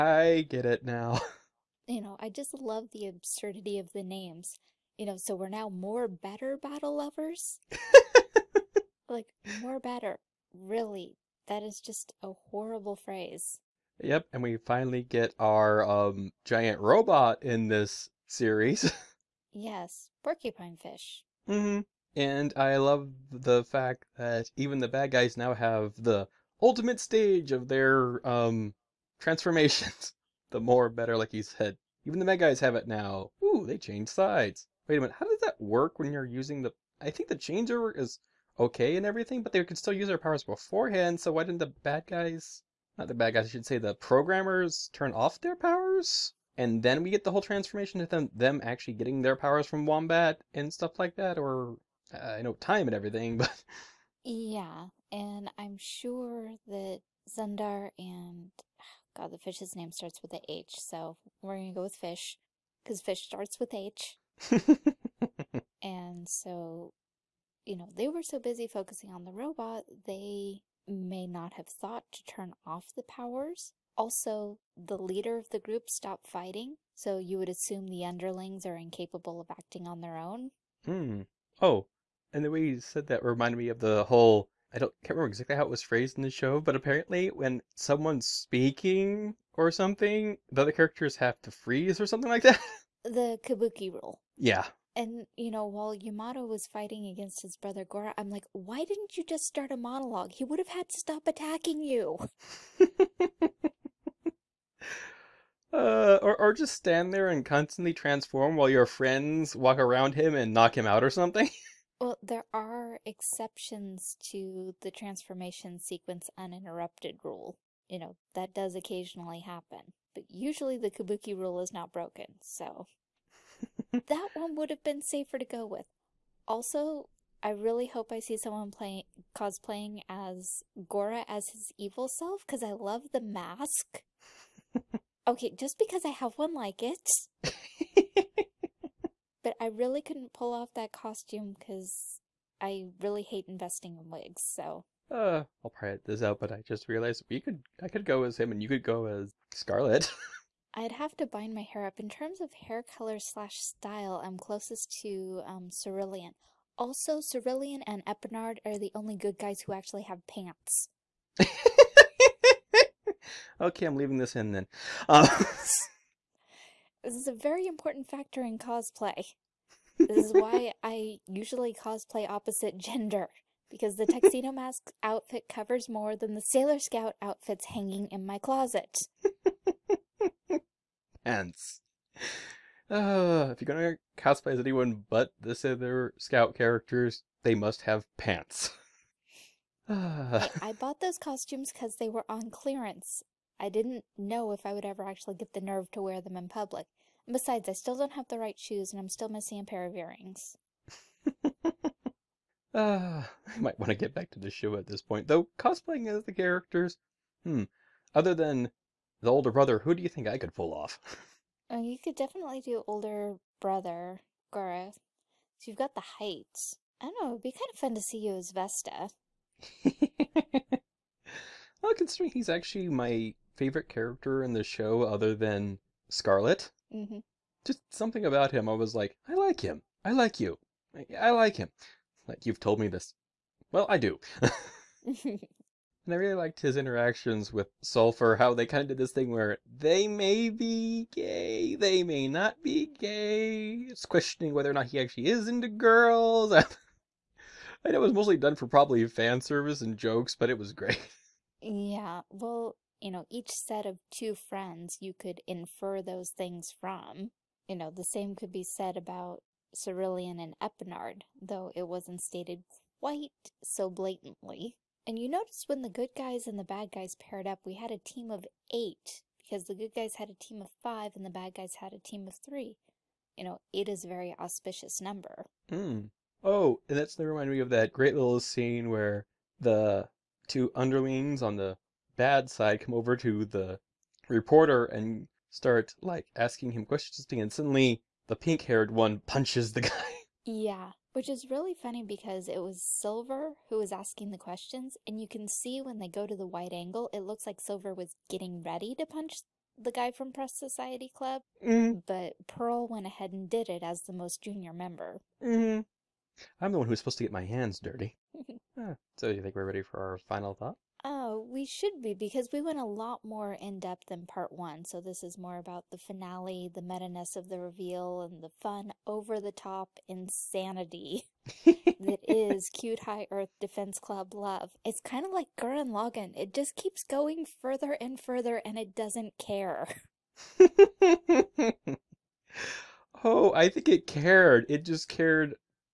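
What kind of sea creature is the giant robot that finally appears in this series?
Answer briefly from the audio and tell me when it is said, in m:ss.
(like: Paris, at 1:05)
Porcupine fish, at 0:20.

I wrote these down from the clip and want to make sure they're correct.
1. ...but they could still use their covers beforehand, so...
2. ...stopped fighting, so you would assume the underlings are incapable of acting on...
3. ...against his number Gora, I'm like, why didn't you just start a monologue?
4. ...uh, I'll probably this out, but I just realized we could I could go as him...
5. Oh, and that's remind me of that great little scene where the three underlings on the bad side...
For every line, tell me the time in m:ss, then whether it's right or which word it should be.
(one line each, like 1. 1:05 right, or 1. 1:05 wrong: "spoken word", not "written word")
1. 0:39 wrong: "powers", not "covers"
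2. 1:15 right
3. 1:37 wrong: "brother", not "number"
4. 2:25 right
5. 4:36 wrong: "two", not "three".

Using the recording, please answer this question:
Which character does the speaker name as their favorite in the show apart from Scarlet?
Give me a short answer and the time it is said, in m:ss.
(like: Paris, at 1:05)
Vesta, at 3:38.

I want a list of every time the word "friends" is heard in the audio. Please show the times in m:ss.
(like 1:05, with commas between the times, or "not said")
1:48, 4:14.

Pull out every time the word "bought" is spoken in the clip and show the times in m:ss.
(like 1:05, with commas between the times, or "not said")
3:10.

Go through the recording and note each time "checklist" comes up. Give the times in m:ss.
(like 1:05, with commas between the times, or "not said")
not said.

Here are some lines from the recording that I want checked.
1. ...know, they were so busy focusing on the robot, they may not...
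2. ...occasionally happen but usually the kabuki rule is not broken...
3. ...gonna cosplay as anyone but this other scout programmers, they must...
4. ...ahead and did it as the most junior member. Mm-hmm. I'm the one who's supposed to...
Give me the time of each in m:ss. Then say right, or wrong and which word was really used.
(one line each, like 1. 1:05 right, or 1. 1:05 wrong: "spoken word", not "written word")
1. 1:07 right
2. 1:58 right
3. 3:03 wrong: "characters", not "programmers"
4. 5:03 right.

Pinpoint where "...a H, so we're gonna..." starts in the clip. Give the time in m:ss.
1:00.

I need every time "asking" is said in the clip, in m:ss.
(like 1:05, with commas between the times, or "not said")
4:46, 4:53.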